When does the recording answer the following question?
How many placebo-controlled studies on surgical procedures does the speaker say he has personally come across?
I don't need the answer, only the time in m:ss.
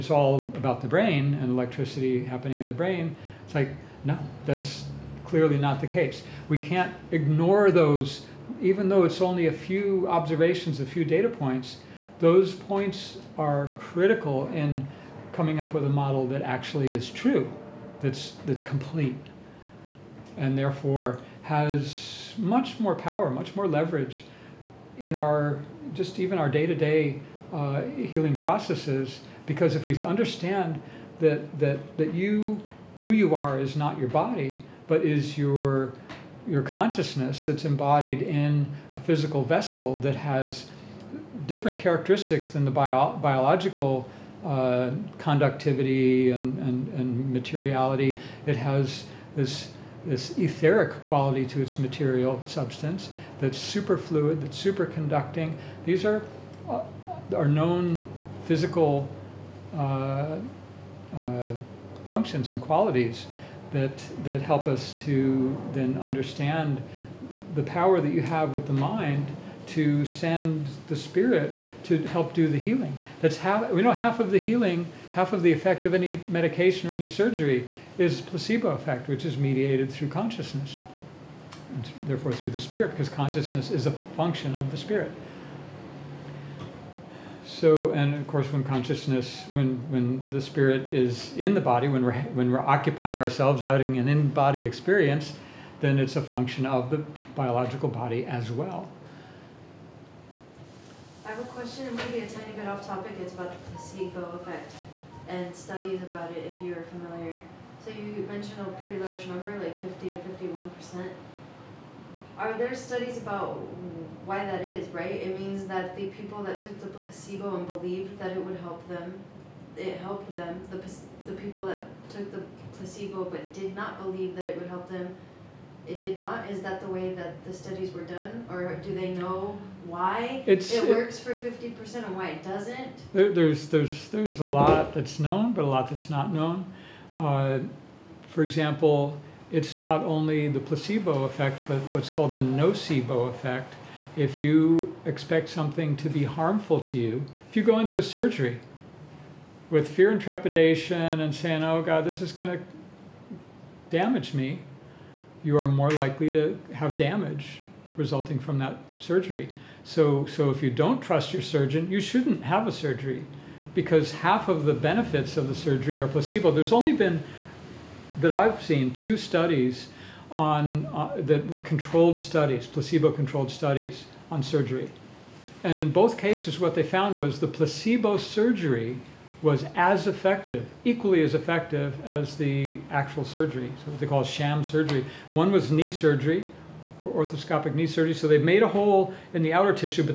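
2:48.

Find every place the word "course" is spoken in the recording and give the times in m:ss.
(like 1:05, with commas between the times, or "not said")
1:28.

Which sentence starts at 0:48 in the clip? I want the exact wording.
It has this, this etheric quality to its material substance that's superfluid, that's superconducting.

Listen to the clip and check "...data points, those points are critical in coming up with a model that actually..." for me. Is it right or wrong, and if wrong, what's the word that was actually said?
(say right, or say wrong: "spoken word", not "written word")
right.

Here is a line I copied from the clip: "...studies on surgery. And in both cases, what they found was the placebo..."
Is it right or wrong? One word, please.
right.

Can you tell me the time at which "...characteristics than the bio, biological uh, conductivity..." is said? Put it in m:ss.
0:41.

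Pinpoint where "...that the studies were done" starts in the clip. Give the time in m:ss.
2:07.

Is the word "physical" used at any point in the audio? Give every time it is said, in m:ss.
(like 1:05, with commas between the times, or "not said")
0:38, 0:58.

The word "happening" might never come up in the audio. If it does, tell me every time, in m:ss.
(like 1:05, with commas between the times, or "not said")
0:02.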